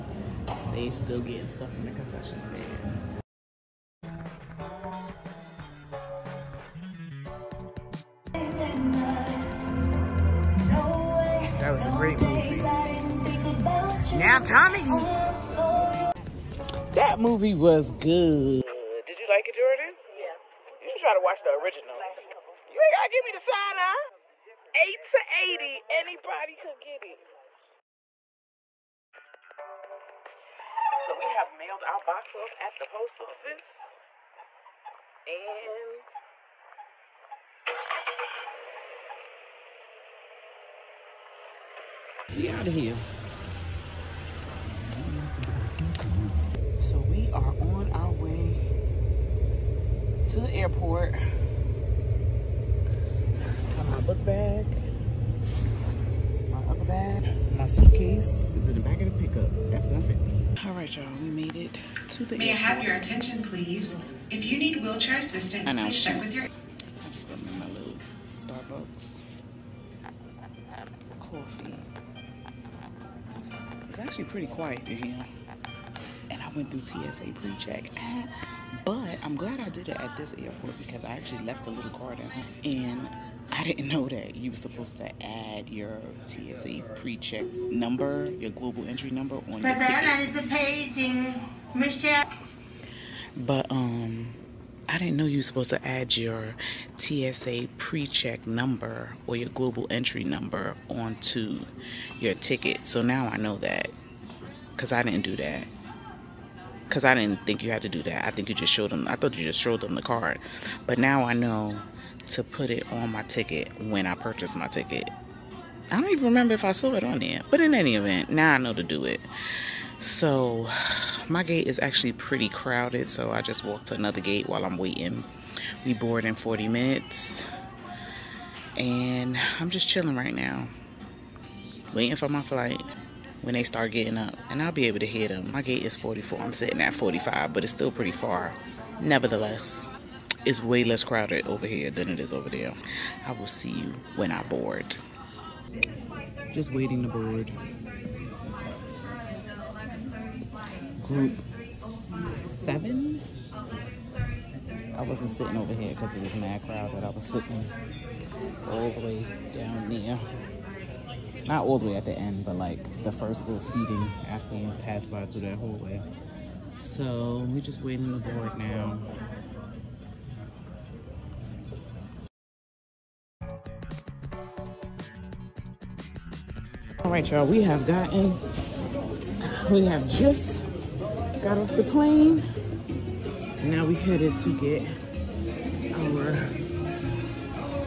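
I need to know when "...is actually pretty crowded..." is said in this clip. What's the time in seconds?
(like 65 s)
121 s.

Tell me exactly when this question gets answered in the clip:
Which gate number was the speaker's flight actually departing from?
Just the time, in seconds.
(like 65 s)
135 s.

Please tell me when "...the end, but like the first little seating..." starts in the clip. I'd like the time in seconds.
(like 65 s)
162 s.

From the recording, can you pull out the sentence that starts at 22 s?
You ain't gotta give me the sign, huh?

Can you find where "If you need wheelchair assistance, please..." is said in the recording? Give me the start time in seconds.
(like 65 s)
64 s.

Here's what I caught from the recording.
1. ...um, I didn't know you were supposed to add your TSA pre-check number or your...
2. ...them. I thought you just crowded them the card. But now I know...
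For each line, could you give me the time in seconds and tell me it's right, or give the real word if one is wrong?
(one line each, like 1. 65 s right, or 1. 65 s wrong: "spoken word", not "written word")
1. 93 s right
2. 108 s wrong: "showed", not "crowded".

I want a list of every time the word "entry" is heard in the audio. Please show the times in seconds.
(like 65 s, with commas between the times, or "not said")
88 s, 99 s.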